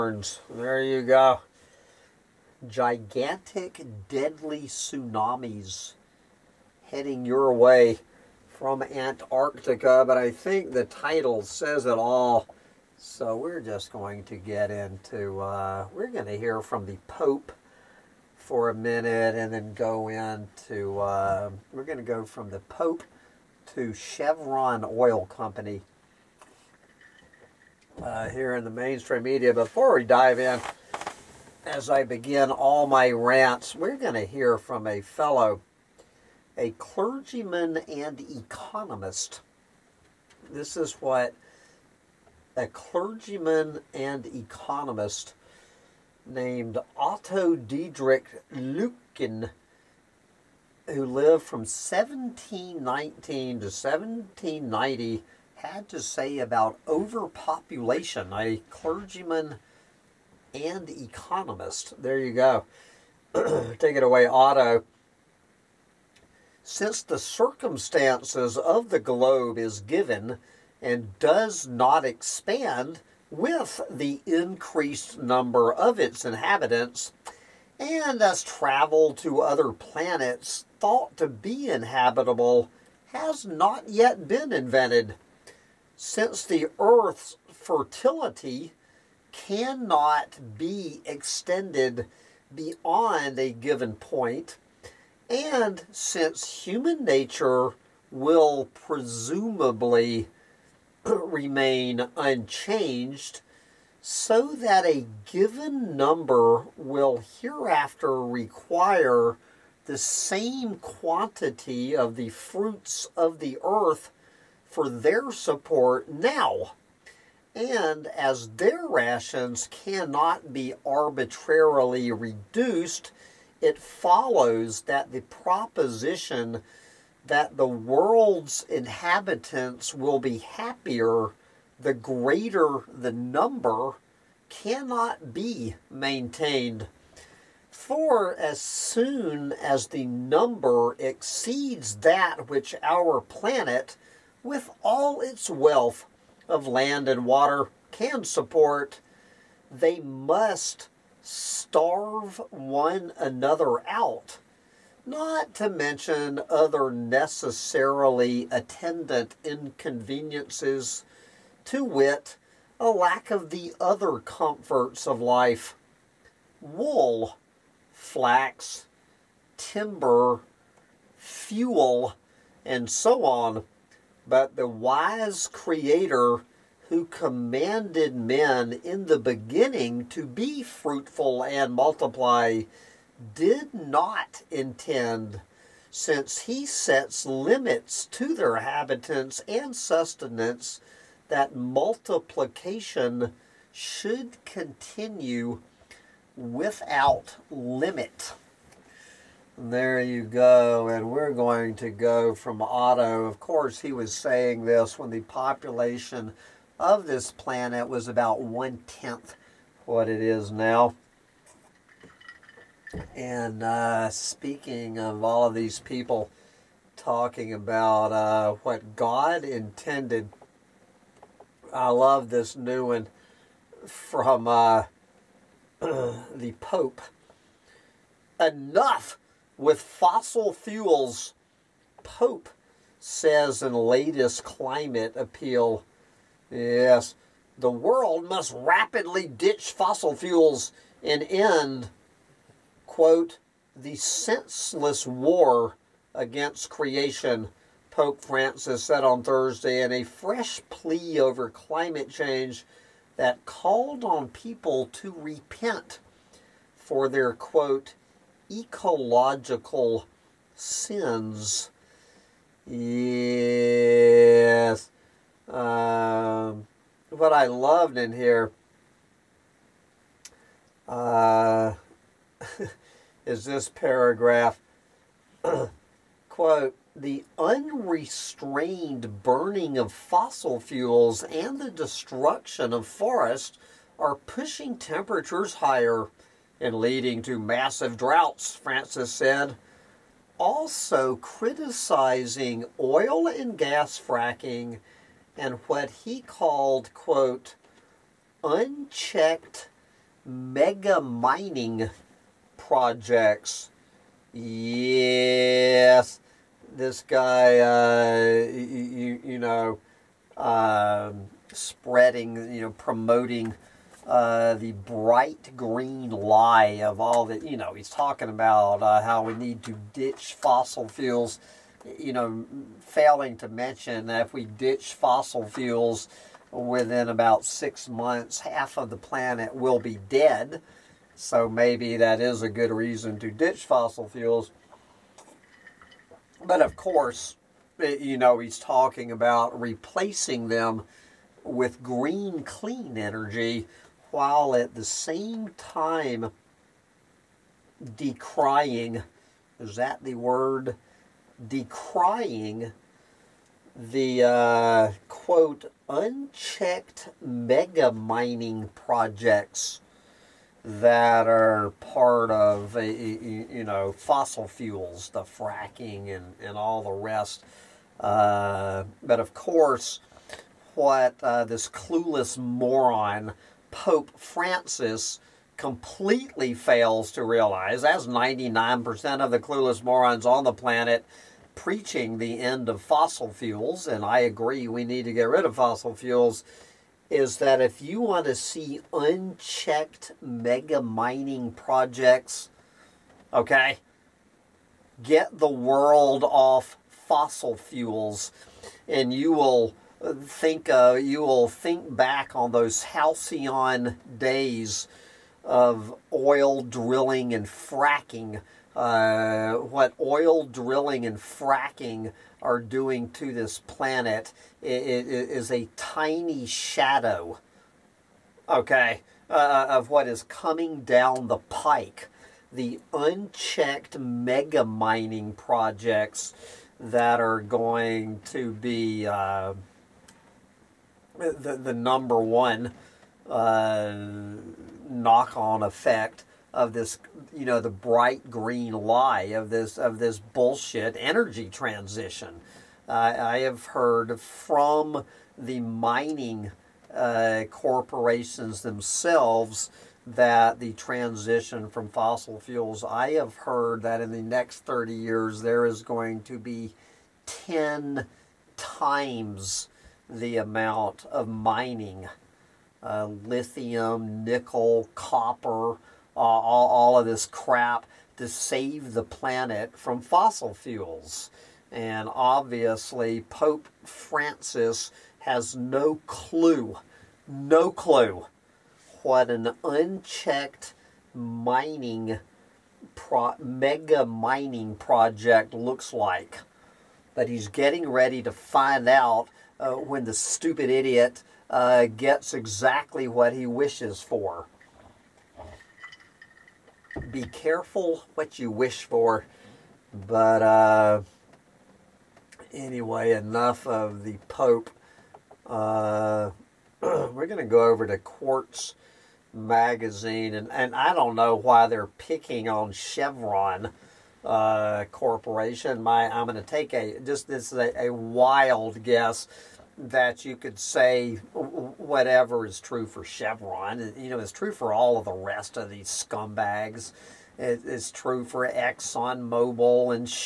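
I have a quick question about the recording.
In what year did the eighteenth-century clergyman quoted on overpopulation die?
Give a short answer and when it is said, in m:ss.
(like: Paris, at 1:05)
1790, at 0:53.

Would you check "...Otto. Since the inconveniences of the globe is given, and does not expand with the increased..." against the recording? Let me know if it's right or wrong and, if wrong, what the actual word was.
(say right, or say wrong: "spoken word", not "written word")
wrong: "circumstances", not "inconveniences".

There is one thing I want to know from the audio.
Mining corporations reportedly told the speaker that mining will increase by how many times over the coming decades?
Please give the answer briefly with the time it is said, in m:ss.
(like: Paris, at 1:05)
10 times, at 7:37.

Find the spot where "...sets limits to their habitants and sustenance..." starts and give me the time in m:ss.
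3:06.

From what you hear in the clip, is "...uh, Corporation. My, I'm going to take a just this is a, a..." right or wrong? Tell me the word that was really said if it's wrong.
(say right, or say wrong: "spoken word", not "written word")
right.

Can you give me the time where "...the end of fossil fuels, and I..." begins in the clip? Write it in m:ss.
6:22.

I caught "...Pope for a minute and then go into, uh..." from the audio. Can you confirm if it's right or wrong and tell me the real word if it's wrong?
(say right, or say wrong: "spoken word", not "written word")
right.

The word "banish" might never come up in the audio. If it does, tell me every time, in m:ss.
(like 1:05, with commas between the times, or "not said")
not said.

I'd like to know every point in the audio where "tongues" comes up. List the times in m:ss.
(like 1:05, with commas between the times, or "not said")
not said.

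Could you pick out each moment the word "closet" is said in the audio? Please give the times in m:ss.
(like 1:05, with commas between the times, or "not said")
not said.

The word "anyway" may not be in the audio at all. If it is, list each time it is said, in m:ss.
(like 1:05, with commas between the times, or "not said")
8:22.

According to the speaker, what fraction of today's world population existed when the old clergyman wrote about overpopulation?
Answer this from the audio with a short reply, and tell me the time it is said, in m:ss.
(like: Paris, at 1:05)
one tenth, at 3:28.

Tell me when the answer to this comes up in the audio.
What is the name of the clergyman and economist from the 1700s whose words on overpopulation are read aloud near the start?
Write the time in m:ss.
0:46.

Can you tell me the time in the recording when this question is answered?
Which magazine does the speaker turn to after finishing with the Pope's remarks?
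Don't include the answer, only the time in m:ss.
8:27.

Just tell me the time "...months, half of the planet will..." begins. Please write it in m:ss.
5:27.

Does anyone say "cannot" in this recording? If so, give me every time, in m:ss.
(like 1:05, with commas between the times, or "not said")
1:29, 1:59, 2:14.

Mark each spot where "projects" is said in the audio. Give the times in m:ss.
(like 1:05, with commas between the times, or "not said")
5:02, 5:58, 6:31, 7:05, 8:04.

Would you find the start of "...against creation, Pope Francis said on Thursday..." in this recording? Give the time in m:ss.
4:06.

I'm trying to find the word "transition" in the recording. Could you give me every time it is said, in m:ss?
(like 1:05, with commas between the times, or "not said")
7:21, 7:30.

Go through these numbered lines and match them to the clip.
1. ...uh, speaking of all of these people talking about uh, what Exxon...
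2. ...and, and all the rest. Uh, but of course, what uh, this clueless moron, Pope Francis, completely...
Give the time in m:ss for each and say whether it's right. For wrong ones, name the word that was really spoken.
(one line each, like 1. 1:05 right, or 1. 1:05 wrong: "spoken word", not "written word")
1. 3:33 wrong: "God", not "Exxon"
2. 6:06 right.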